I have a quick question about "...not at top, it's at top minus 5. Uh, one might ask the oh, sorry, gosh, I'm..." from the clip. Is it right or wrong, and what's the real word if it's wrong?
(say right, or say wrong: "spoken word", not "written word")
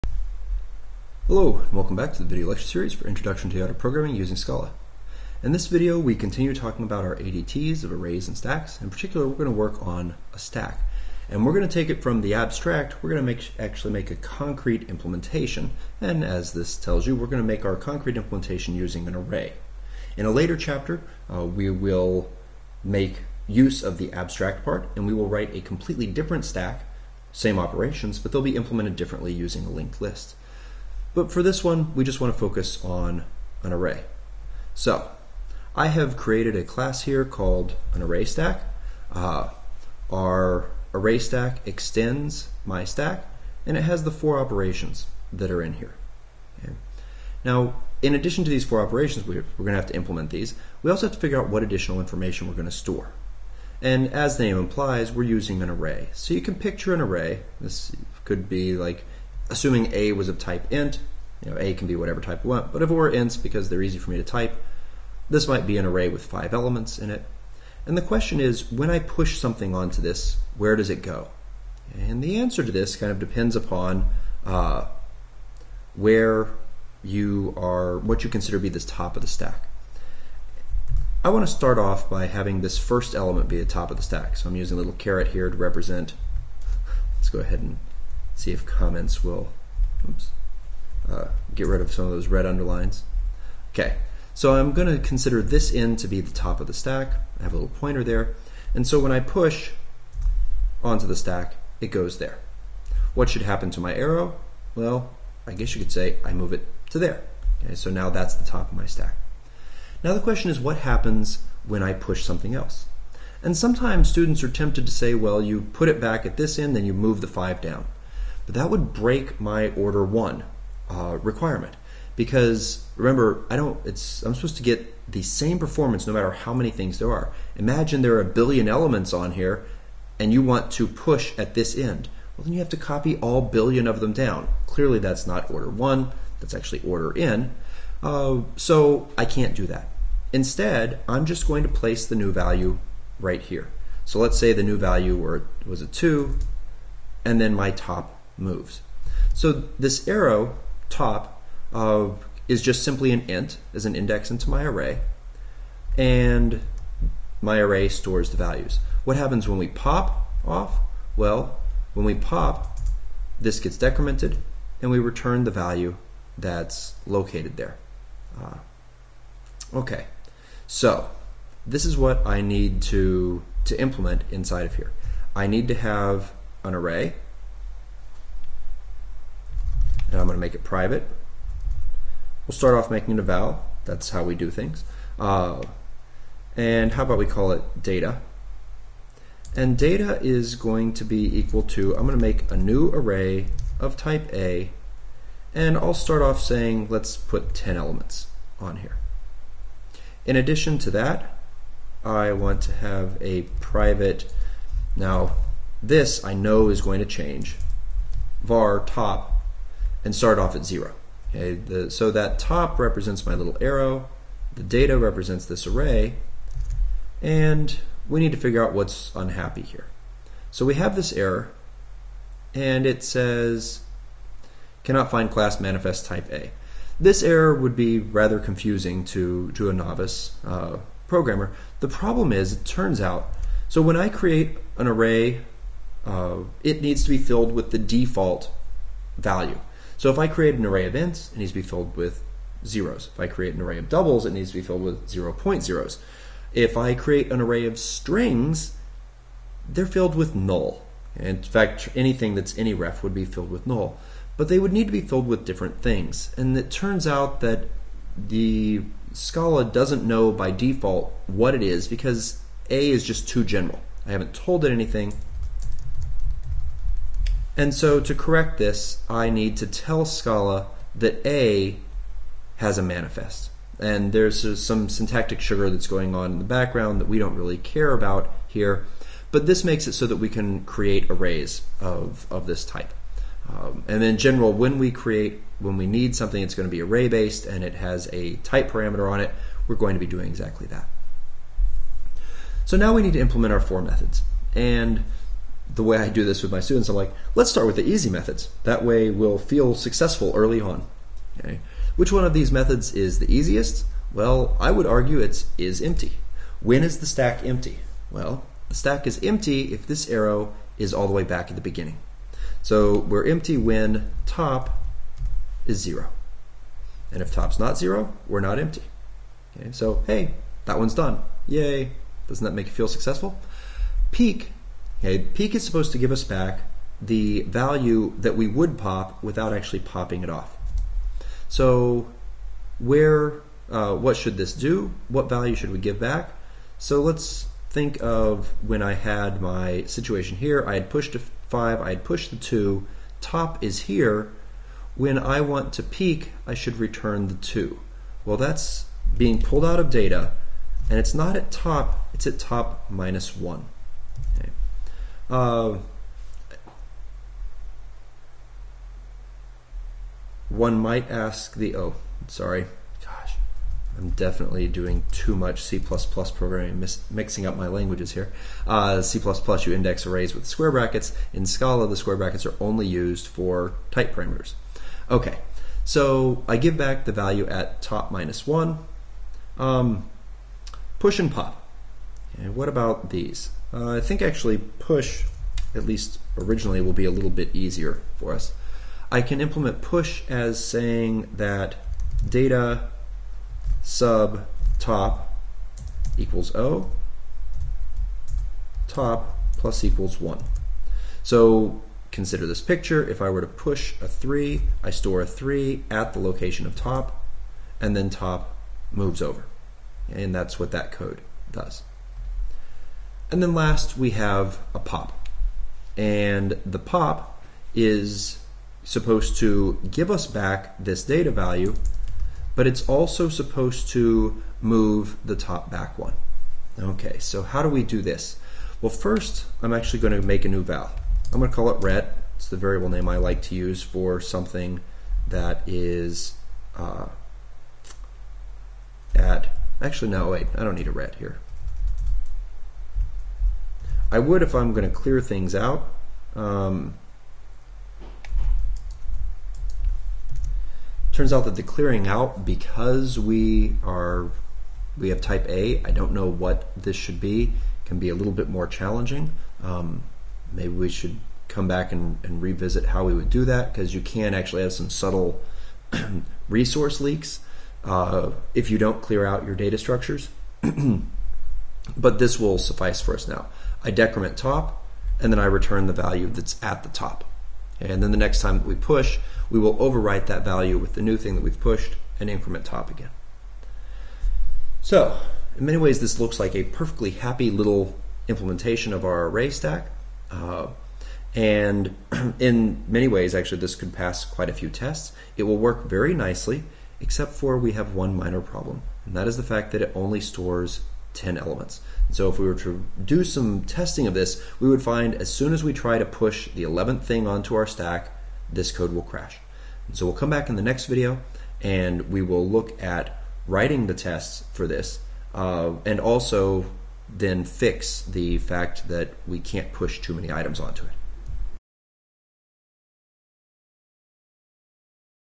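wrong: "1", not "5".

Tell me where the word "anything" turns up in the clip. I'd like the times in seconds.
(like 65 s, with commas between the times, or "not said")
251 s, 264 s.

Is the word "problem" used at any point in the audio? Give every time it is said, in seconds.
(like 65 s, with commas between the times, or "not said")
231 s, 498 s.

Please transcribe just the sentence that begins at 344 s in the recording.
When I want to peek, I should return the 2.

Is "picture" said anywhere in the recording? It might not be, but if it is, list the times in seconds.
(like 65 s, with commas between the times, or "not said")
56 s, 402 s.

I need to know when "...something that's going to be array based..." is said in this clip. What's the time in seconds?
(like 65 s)
286 s.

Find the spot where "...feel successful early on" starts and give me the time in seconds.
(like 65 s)
299 s.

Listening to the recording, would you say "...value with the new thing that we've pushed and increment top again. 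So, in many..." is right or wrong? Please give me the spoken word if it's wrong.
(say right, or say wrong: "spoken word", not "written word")
right.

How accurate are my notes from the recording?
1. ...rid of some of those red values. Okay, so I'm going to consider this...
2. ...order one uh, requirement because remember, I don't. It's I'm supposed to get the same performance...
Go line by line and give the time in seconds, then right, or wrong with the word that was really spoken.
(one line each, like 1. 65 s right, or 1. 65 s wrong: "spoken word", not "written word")
1. 91 s wrong: "underlines", not "values"
2. 119 s right.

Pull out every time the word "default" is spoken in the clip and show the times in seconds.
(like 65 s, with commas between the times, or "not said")
237 s, 260 s.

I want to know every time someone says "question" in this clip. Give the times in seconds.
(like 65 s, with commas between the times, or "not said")
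68 s, 110 s.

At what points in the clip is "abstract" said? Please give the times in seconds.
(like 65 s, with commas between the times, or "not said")
12 s, 24 s.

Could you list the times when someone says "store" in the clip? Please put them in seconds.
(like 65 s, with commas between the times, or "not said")
52 s, 157 s, 404 s, 500 s.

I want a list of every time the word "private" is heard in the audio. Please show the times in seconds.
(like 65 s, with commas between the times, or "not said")
180 s, 203 s.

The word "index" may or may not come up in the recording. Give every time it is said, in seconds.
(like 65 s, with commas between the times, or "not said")
153 s, 369 s.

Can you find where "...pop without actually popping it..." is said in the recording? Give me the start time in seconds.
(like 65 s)
328 s.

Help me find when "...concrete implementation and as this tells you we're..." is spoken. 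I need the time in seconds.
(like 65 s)
14 s.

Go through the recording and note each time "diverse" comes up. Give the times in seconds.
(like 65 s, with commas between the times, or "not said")
not said.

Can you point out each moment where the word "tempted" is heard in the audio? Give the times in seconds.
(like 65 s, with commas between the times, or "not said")
114 s.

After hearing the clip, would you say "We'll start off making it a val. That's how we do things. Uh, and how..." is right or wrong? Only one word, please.
right.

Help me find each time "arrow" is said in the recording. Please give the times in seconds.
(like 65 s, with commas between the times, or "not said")
103 s, 150 s, 213 s, 310 s.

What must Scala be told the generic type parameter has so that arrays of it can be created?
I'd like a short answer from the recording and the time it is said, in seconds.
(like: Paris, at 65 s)
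a manifest, at 272 s.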